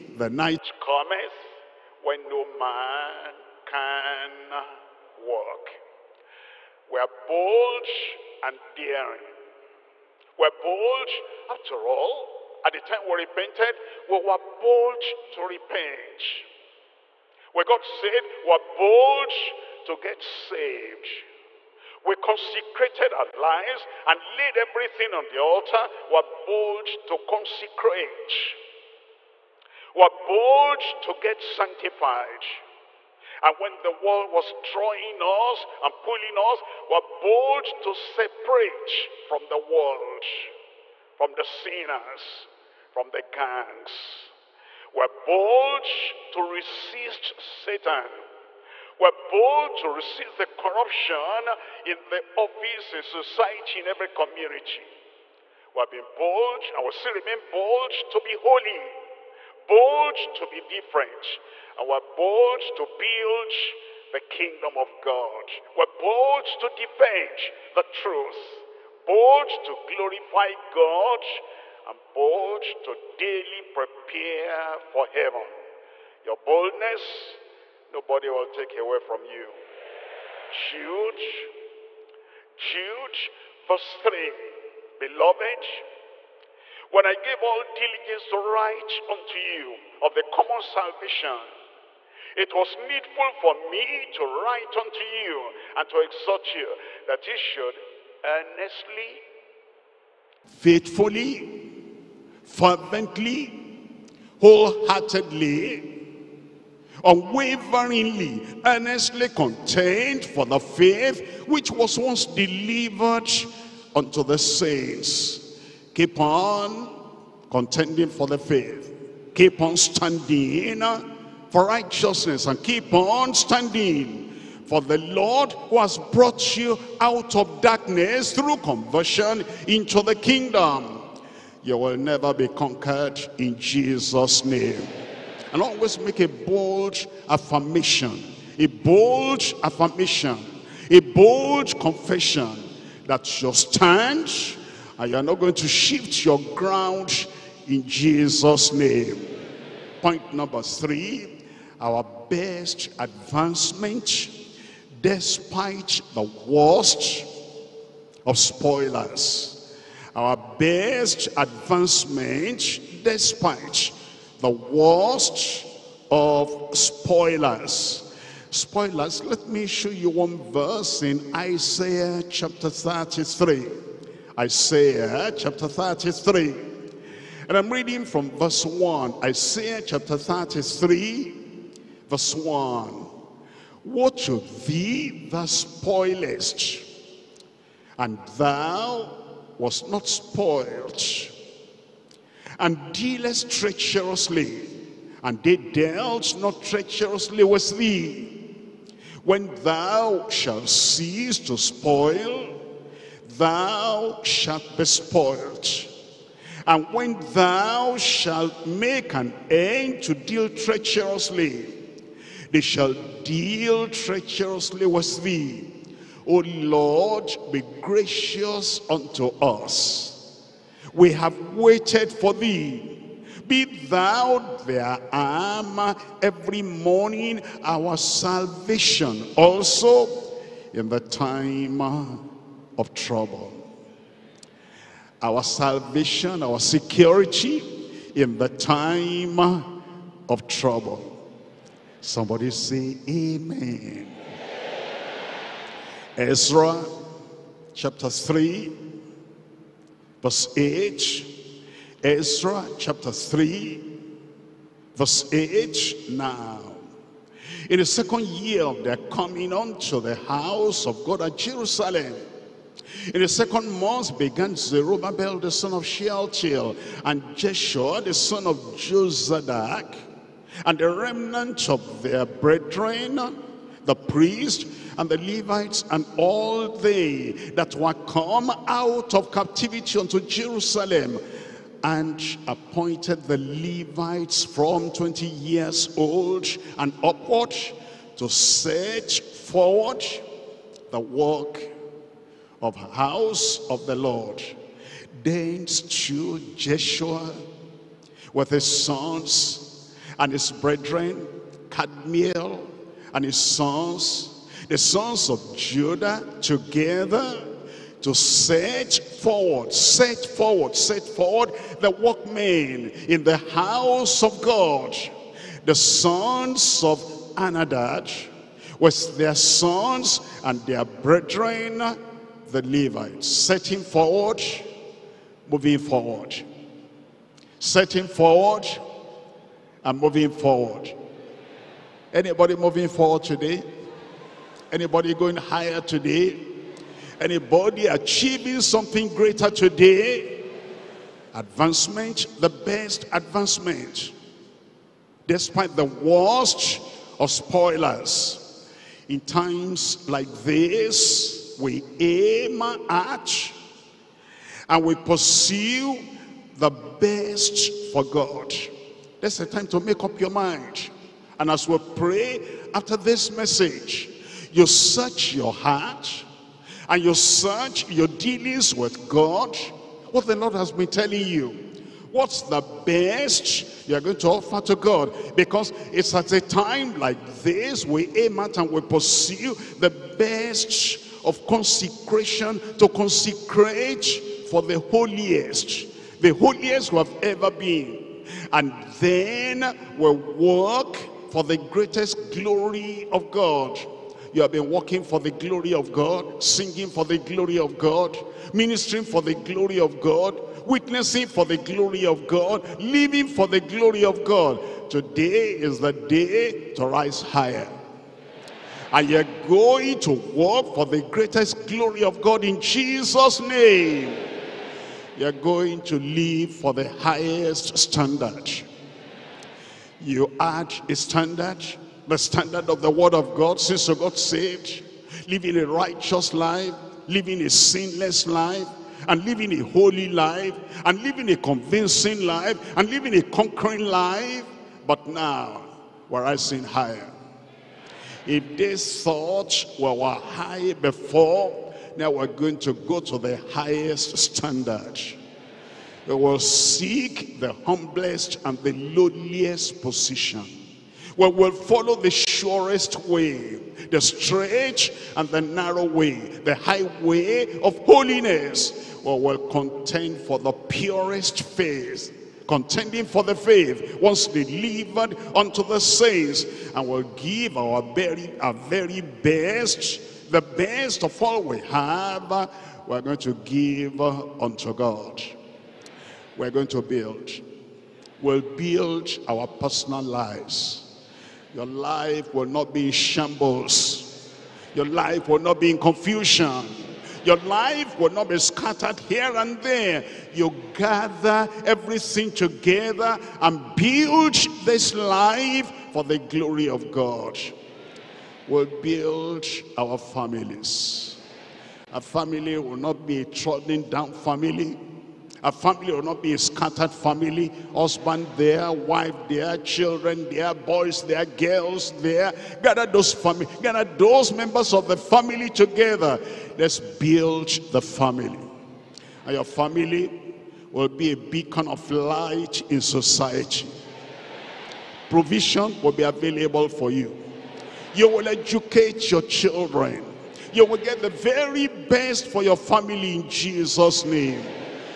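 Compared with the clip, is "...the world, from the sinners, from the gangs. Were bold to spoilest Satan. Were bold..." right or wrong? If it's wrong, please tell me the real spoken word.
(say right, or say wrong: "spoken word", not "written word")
wrong: "resist", not "spoilest".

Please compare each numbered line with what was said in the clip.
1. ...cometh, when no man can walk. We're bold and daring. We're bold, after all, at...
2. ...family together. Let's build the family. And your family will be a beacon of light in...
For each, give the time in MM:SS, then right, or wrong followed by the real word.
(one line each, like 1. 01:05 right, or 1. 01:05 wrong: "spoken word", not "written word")
1. 00:00 right
2. 08:34 right.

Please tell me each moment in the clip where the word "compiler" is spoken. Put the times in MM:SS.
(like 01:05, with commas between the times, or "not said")
not said.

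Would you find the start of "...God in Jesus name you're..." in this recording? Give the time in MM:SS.
06:52.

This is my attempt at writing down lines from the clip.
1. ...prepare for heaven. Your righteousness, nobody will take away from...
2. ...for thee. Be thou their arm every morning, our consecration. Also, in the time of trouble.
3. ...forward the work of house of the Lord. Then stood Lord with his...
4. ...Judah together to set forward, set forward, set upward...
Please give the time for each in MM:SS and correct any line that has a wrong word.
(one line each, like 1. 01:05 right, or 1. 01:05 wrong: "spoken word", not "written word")
1. 01:13 wrong: "boldness", not "righteousness"
2. 03:42 wrong: "salvation", not "consecration"
3. 04:49 wrong: "Jeshua", not "Lord"
4. 05:05 wrong: "forward", not "upward".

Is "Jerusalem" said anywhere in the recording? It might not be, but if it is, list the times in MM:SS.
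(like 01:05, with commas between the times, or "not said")
04:21, 04:40.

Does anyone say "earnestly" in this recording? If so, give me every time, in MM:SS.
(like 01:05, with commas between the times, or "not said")
01:38, 01:48.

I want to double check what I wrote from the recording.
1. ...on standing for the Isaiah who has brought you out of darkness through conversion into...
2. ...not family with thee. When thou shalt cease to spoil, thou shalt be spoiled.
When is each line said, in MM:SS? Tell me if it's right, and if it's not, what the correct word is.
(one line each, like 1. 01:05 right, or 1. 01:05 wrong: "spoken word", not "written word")
1. 02:02 wrong: "Lord", not "Isaiah"
2. 03:16 wrong: "treacherously", not "family".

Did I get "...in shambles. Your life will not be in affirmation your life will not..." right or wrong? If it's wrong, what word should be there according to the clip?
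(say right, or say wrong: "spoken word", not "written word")
wrong: "confusion", not "affirmation".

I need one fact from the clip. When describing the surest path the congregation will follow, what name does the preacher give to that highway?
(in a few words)
highway of holiness.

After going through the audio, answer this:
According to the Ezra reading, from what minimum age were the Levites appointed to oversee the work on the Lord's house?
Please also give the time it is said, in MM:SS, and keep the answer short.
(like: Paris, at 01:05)
20, at 04:44.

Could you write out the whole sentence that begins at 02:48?
Spoilers, let me show you one verse in Isaiah chapter 33.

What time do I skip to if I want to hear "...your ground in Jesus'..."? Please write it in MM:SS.
02:26.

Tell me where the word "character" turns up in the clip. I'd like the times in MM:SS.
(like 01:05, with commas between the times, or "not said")
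not said.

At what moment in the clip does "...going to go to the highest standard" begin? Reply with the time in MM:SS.
07:22.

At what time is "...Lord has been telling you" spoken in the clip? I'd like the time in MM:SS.
06:10.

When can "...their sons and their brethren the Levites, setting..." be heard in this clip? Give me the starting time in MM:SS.
05:19.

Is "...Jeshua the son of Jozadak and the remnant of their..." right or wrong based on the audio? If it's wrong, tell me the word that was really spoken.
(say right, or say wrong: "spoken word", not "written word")
right.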